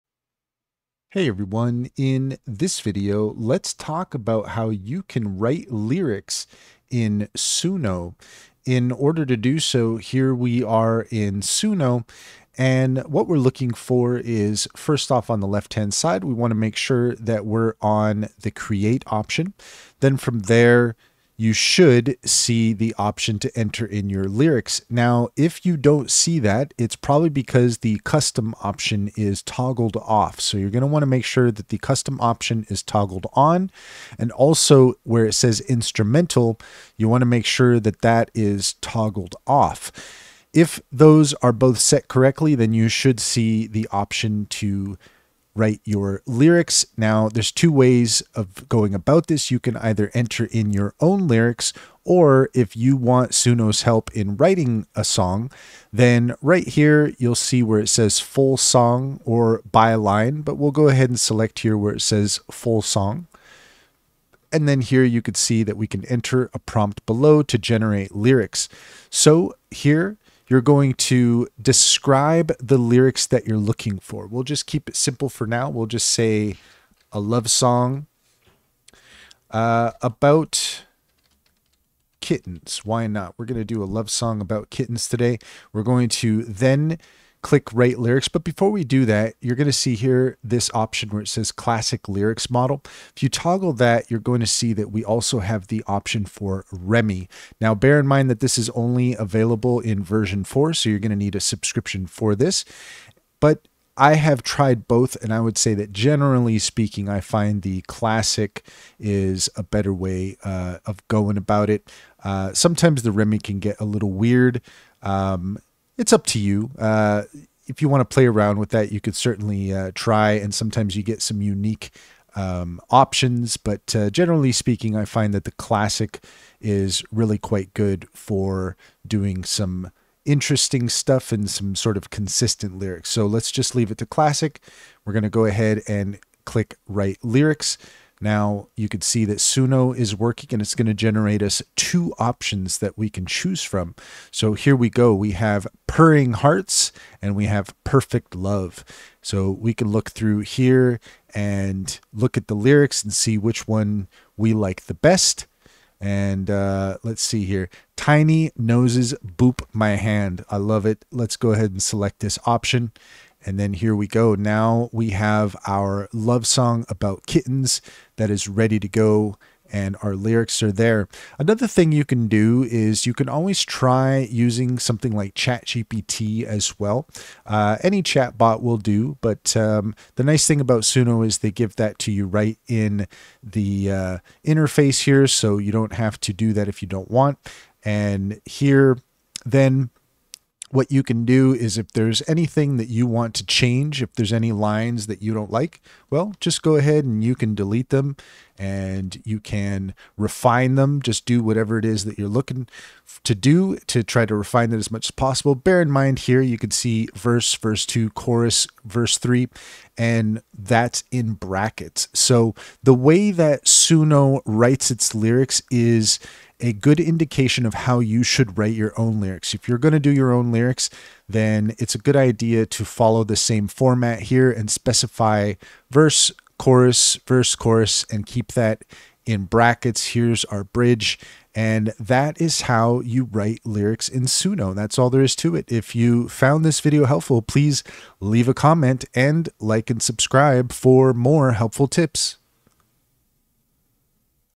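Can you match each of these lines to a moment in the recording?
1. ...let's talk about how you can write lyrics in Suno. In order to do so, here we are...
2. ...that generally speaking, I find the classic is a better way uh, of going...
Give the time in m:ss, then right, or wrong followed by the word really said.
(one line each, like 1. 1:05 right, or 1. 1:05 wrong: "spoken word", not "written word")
1. 0:03 right
2. 1:45 right.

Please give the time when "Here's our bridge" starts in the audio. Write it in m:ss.
3:50.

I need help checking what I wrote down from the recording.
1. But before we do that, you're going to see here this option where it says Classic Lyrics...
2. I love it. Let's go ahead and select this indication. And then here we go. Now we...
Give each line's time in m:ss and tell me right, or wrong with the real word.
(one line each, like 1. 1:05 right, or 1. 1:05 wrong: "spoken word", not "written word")
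1. 1:28 right
2. 2:40 wrong: "option", not "indication".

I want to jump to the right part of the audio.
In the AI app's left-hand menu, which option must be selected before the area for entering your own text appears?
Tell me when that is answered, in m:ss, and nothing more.
0:18.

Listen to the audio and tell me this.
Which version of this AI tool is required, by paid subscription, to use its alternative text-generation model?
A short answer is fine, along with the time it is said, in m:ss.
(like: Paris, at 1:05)
Version 4, at 1:40.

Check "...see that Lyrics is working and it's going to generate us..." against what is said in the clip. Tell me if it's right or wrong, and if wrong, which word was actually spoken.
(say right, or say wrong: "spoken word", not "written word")
wrong: "Suno", not "Lyrics".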